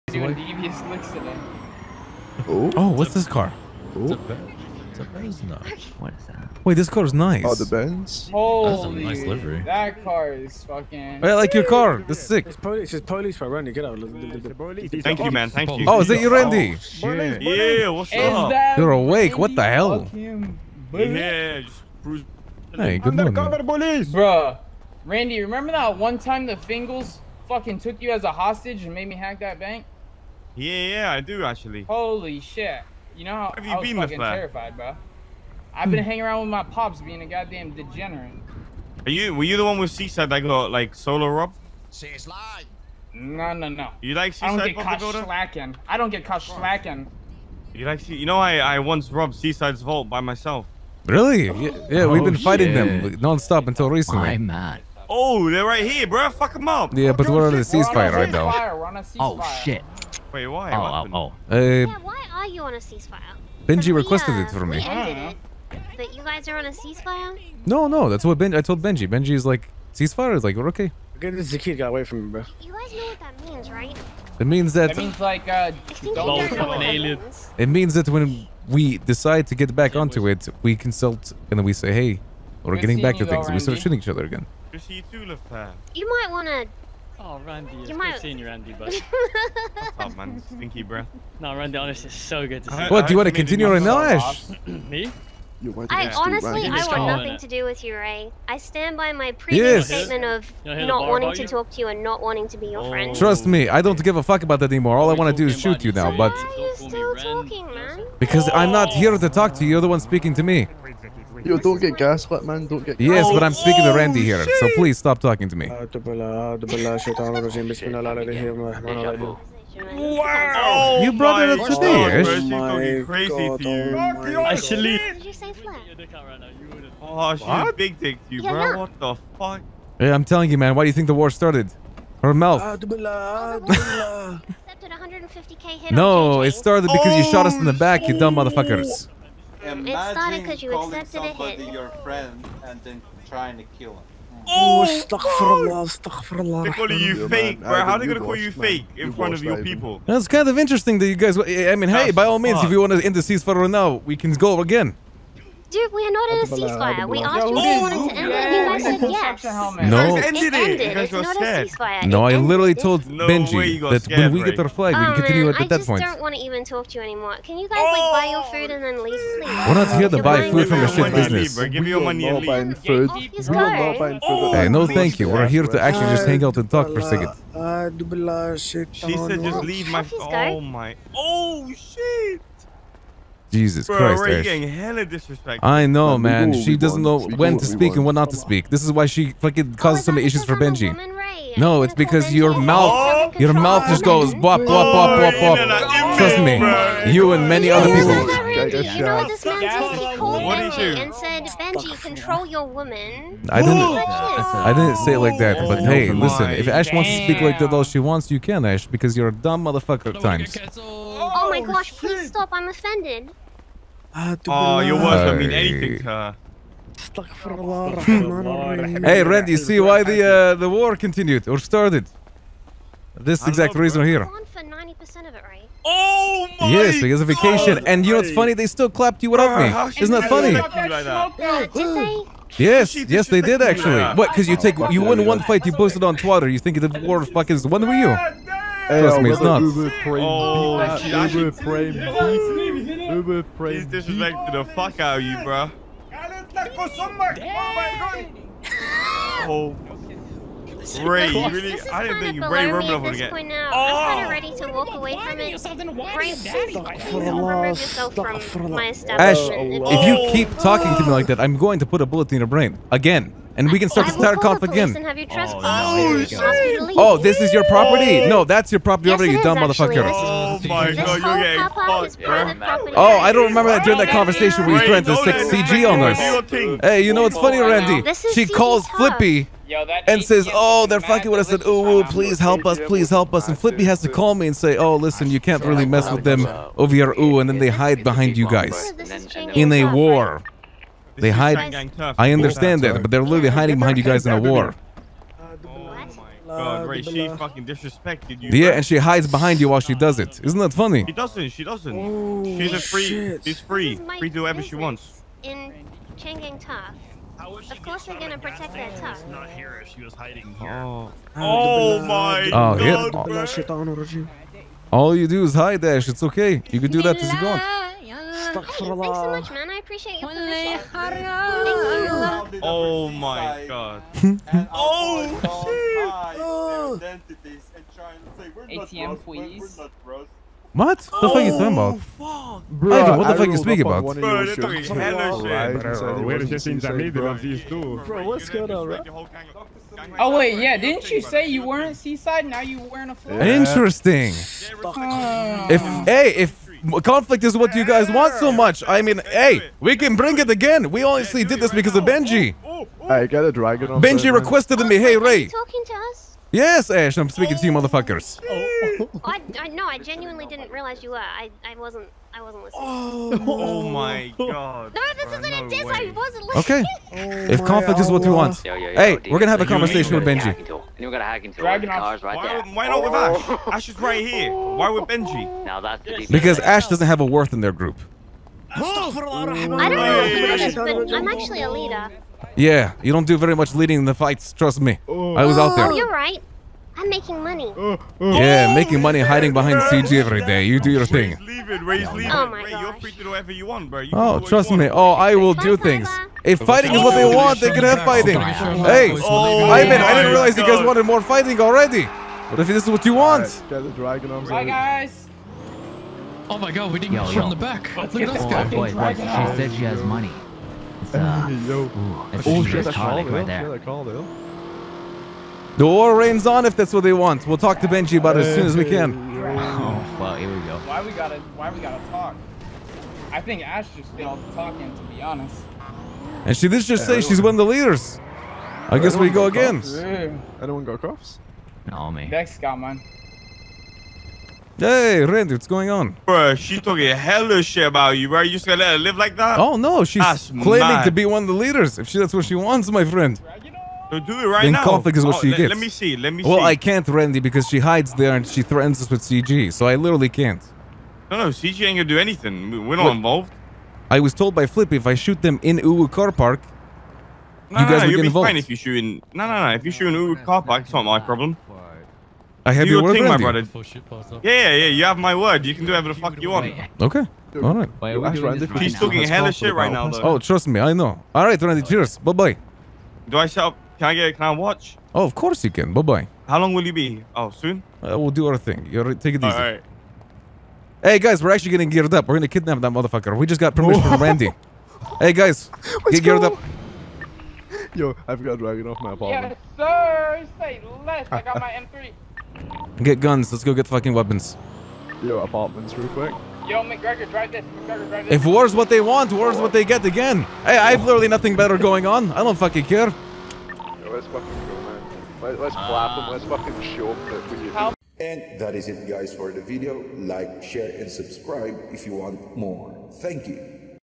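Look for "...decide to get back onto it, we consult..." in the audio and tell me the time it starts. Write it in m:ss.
1:18.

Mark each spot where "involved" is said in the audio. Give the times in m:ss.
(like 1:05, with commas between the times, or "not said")
7:33, 7:38.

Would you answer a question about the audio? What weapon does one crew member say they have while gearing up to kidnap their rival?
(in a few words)
M3.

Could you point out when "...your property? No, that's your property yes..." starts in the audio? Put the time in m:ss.
4:27.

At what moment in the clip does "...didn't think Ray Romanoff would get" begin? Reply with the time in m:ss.
4:12.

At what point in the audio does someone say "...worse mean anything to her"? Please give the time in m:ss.
3:34.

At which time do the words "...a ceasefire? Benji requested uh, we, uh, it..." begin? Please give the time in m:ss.
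1:02.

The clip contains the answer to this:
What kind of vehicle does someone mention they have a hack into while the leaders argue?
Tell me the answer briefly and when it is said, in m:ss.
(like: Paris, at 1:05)
Dragon cars, at 6:11.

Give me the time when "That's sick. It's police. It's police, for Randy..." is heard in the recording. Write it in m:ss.
0:12.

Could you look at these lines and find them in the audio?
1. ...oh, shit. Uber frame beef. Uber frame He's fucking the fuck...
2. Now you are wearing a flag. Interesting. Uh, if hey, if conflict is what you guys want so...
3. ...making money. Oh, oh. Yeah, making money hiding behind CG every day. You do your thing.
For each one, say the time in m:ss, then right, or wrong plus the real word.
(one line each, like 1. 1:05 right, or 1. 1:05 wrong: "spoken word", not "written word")
1. 4:00 wrong: "disrespecting", not "fucking"
2. 5:42 right
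3. 6:27 right.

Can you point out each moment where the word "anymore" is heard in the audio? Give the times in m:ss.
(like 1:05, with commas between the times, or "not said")
1:44, 2:47.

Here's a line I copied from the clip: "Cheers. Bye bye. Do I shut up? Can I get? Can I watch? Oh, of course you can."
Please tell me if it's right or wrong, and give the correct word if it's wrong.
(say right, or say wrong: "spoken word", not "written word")
right.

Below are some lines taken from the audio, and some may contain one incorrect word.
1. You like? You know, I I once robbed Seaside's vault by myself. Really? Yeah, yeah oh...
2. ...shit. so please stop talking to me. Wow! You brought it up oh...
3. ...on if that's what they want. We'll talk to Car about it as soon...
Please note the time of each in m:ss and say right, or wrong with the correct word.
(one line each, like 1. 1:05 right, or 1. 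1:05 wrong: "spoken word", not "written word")
1. 0:47 right
2. 1:54 right
3. 6:56 wrong: "Benji", not "Car".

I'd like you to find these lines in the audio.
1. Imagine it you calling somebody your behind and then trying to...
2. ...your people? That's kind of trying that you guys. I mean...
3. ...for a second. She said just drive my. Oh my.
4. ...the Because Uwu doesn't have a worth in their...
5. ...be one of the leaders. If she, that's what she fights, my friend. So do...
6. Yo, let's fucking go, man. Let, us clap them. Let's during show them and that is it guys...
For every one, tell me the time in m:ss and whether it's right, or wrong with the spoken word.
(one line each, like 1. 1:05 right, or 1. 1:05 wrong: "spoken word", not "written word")
1. 2:19 wrong: "friend", not "behind"
2. 2:29 wrong: "interesting", not "trying"
3. 2:56 wrong: "leave", not "drive"
4. 6:16 wrong: "Ash", not "Uwu"
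5. 7:21 wrong: "wants", not "fights"
6. 8:23 wrong: "fucking", not "during".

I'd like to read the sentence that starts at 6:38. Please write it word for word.
Hey, oh I mean, I didn't realize you guys wanted more fighting already.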